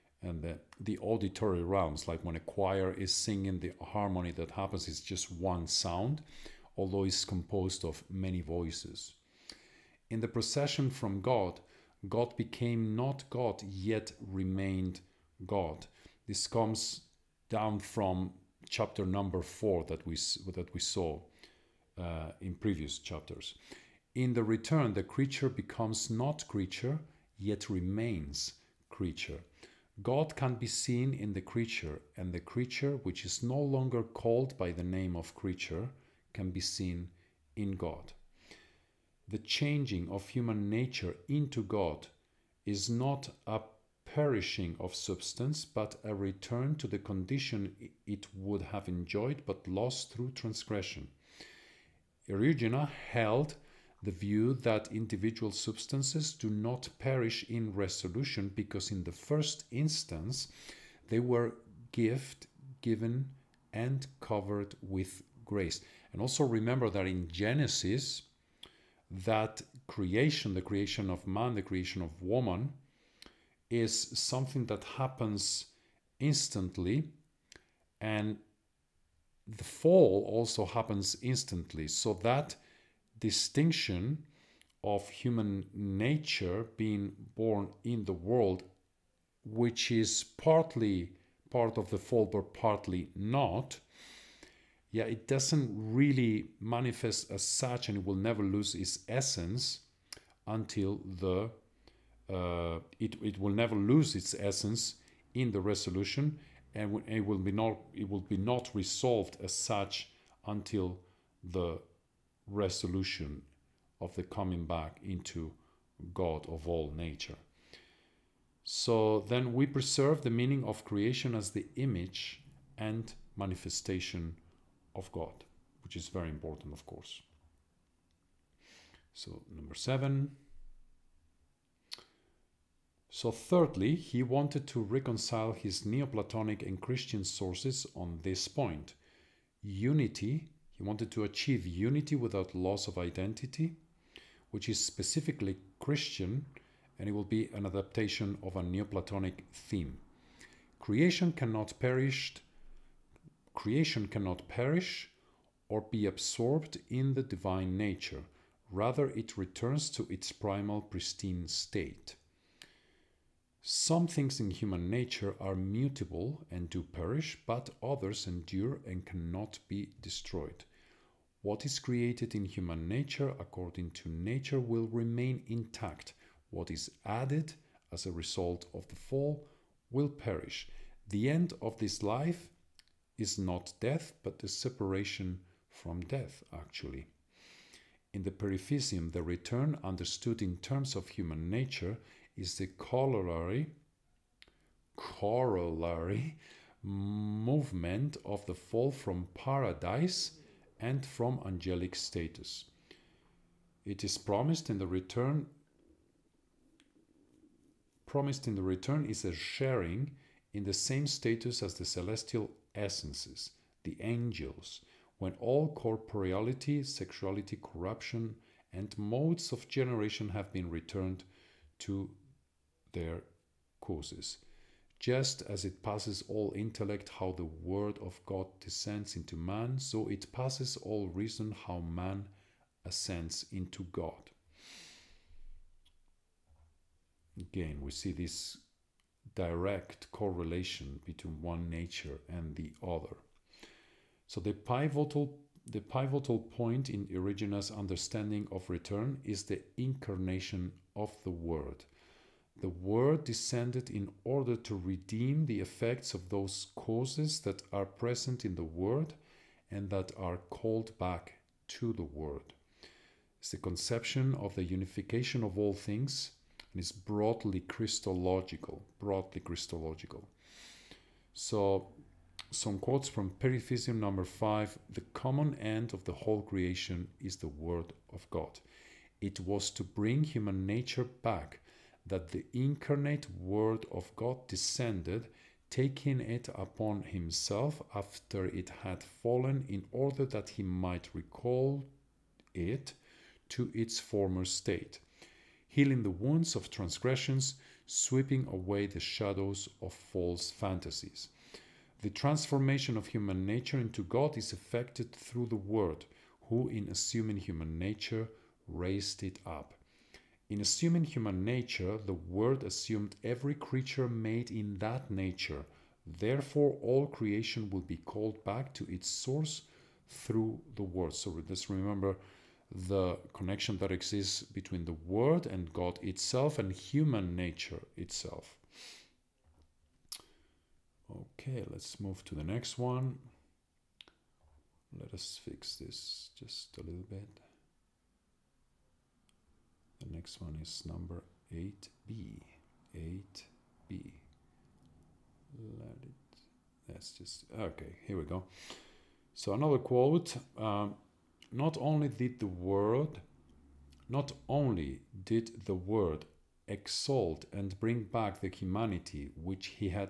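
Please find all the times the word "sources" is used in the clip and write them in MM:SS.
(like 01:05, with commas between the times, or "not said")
02:17, 05:19.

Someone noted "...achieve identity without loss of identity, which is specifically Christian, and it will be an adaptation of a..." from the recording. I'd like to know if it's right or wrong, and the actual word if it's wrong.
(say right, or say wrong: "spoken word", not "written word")
wrong: "unity", not "identity".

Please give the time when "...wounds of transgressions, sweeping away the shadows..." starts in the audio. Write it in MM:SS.
04:56.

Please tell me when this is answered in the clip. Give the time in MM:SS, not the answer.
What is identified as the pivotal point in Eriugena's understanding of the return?
04:09.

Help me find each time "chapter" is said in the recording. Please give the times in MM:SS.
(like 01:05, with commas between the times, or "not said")
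00:18, 00:22.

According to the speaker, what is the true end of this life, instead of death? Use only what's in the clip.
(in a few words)
Separation from death.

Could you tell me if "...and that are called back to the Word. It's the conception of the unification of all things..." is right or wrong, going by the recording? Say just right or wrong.
right.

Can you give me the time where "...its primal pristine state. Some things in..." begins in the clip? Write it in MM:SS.
02:40.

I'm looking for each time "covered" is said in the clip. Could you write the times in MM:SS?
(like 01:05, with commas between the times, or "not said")
01:04.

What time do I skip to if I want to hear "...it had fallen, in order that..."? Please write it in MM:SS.
04:48.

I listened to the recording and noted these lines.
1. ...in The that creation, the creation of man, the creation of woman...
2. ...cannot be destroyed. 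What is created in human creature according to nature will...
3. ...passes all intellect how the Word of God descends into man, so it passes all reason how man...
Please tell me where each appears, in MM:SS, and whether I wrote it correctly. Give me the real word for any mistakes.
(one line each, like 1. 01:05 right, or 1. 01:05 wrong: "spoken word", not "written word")
1. 01:07 wrong: "Genesis", not "The"
2. 02:49 wrong: "nature", not "creature"
3. 03:45 right.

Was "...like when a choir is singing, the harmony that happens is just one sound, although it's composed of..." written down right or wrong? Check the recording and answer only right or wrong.
right.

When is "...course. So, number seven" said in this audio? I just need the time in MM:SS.
02:06.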